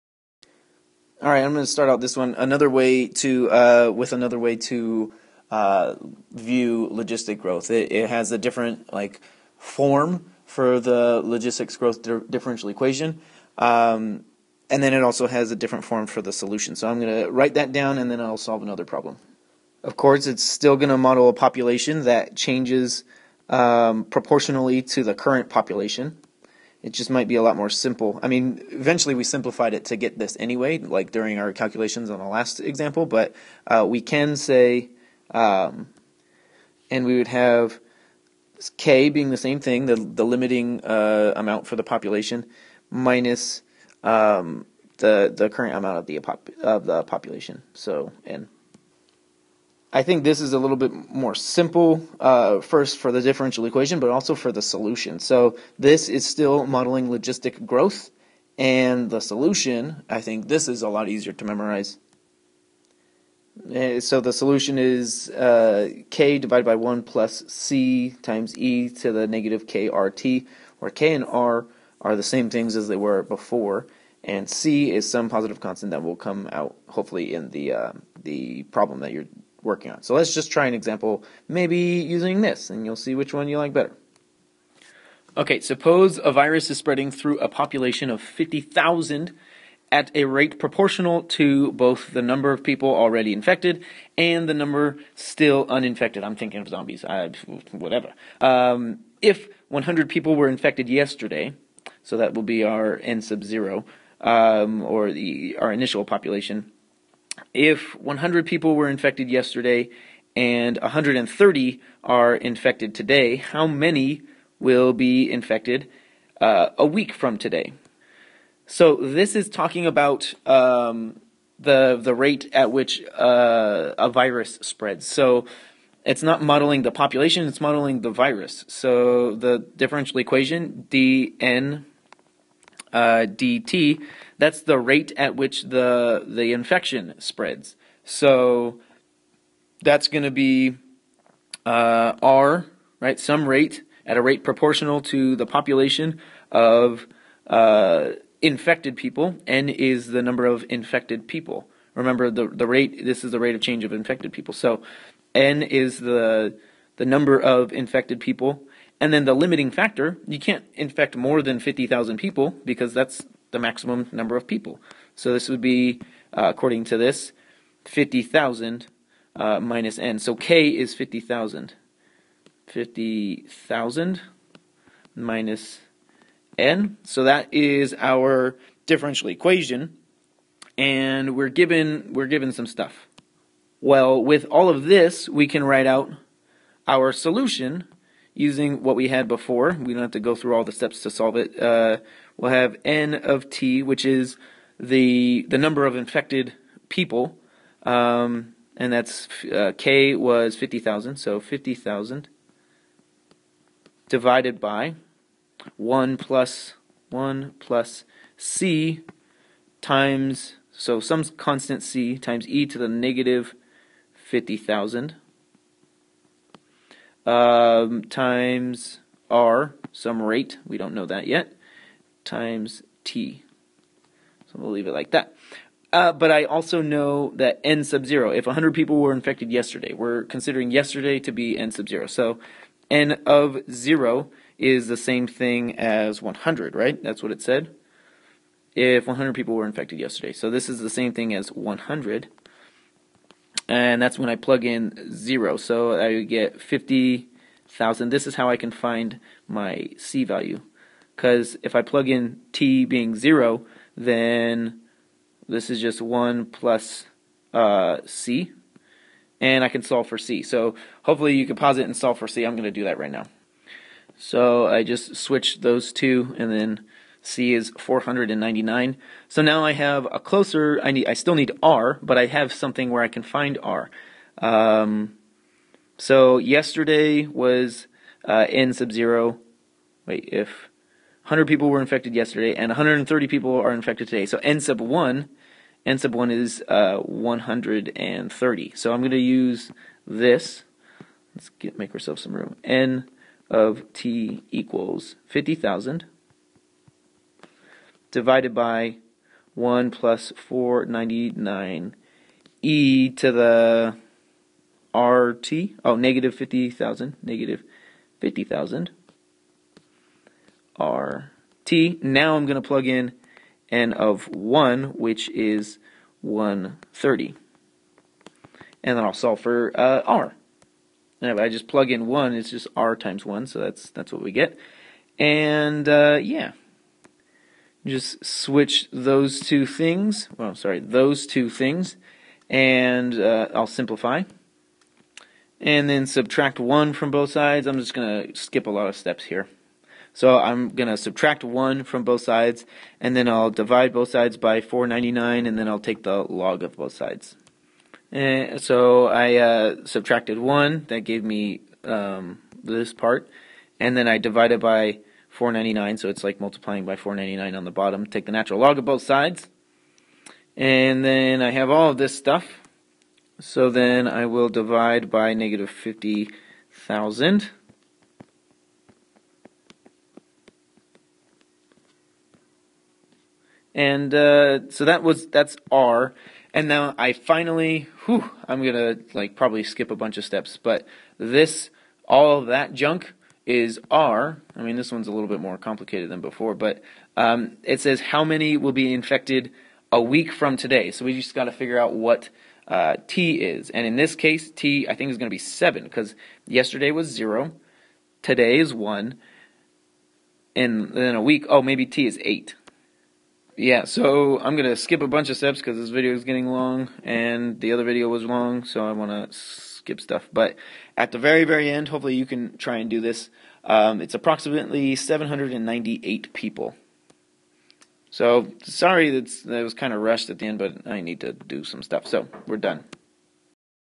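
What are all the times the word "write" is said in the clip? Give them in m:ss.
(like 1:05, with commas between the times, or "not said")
0:17, 3:05.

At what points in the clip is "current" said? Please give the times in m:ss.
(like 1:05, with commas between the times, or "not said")
0:25, 0:45.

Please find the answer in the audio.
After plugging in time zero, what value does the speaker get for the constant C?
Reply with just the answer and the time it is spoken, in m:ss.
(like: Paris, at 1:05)
499, at 4:27.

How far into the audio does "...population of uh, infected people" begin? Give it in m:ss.
2:25.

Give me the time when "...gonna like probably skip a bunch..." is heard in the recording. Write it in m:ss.
6:18.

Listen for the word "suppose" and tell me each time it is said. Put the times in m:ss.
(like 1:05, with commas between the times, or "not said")
1:25.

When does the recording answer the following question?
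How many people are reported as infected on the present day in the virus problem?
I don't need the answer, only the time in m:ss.
4:44.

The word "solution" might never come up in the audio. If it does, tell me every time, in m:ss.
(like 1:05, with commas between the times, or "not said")
0:16, 0:54, 0:59, 1:04, 3:07.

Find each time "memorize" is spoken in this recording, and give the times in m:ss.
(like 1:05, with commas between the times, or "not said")
1:01.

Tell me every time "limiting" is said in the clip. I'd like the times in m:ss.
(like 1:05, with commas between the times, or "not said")
0:40, 2:39.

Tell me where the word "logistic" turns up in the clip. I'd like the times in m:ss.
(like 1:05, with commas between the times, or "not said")
0:06, 0:11, 0:57.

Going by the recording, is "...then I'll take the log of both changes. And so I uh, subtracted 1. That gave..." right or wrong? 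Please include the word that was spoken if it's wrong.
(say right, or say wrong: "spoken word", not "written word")
wrong: "sides", not "changes".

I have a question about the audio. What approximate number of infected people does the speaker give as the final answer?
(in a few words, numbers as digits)
798.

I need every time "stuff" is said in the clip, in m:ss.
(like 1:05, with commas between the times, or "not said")
3:02, 6:02, 6:49, 7:01.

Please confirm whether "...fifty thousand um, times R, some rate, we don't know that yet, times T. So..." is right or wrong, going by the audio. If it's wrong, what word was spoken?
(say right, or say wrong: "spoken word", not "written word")
right.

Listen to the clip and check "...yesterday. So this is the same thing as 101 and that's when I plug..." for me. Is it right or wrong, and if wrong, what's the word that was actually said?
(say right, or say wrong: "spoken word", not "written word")
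wrong: "100", not "101".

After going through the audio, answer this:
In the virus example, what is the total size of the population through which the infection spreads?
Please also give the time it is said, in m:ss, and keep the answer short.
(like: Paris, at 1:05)
50,000, at 1:27.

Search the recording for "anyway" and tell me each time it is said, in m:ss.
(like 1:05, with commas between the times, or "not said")
0:30.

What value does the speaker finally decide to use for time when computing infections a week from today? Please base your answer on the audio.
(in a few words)
8.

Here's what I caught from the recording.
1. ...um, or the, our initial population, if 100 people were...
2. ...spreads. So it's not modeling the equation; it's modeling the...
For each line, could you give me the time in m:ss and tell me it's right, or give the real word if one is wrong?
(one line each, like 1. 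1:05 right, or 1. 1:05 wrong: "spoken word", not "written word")
1. 1:44 right
2. 2:04 wrong: "population", not "equation".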